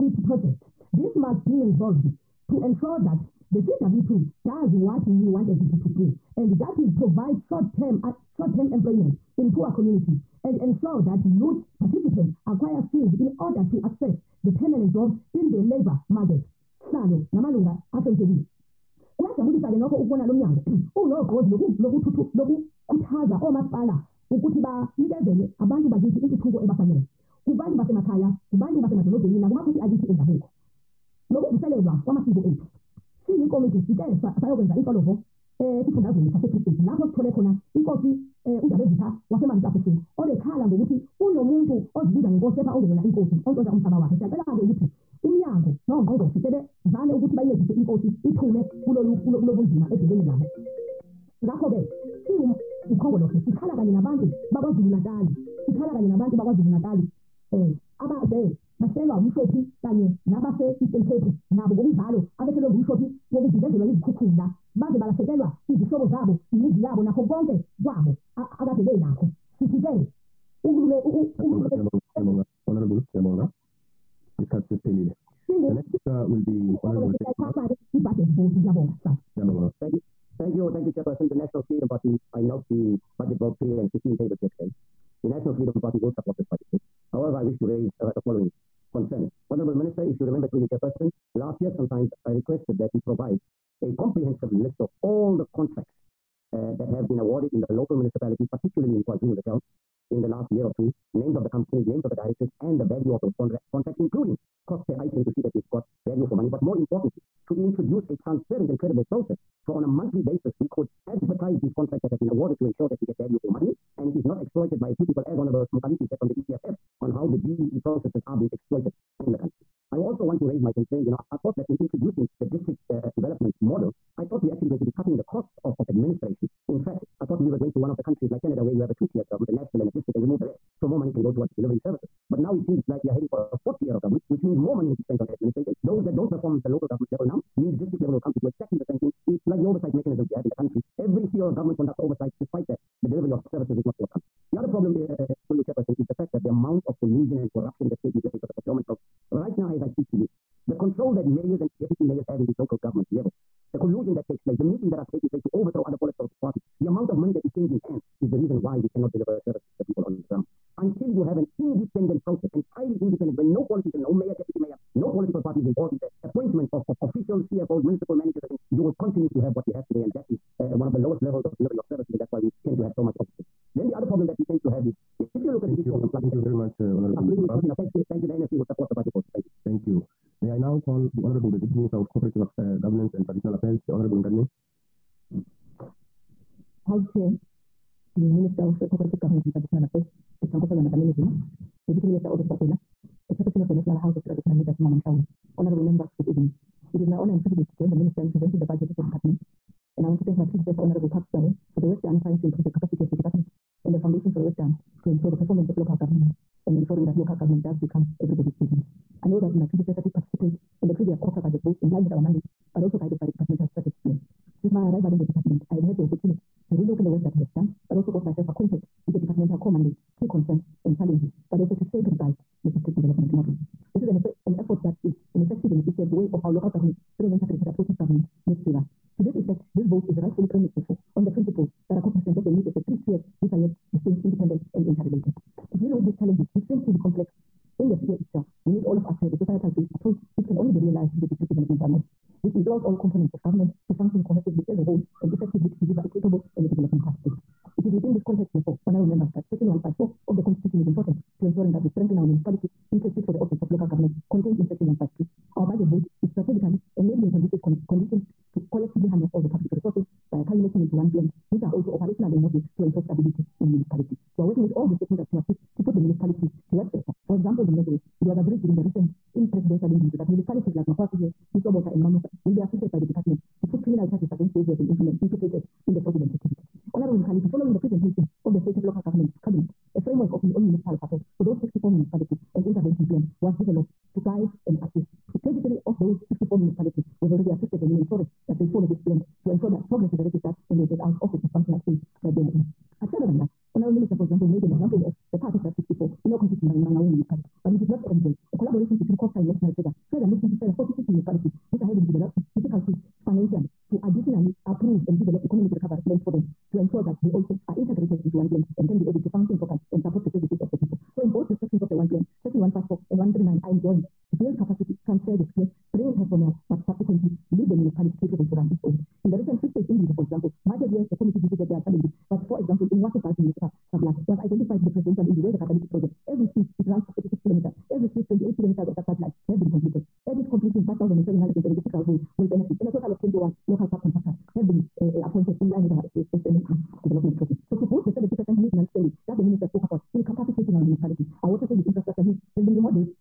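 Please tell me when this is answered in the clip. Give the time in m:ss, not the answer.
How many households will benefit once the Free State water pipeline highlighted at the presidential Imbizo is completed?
5:30.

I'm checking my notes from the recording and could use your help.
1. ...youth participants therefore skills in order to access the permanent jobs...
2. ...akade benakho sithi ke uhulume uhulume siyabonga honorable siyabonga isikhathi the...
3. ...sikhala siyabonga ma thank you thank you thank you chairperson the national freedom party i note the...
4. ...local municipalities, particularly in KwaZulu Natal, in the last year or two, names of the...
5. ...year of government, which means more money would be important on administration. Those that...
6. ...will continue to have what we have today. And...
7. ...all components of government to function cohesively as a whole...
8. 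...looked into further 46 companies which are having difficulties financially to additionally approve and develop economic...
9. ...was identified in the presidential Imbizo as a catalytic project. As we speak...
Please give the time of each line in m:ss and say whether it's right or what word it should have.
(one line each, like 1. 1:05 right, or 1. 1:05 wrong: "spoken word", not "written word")
1. 0:11 wrong: "acquire", not "therefore"
2. 1:08 right
3. 1:19 wrong: "sihlala", not "sikhala"
4. 1:37 right
5. 2:13 wrong: "spent", not "important"
6. 2:48 right
7. 4:02 right
8. 5:00 wrong: "municipalities", not "companies"
9. 5:24 right.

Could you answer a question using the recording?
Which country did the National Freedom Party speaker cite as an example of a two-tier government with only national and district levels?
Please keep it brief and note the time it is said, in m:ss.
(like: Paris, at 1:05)
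Canada, at 2:08.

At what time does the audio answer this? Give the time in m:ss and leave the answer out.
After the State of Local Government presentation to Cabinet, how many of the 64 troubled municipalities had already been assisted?
4:45.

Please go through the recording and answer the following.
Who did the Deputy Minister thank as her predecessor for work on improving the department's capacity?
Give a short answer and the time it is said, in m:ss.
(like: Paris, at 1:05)
Parks Tau, at 3:21.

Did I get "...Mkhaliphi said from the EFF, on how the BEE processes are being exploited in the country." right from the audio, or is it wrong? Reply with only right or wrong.
right.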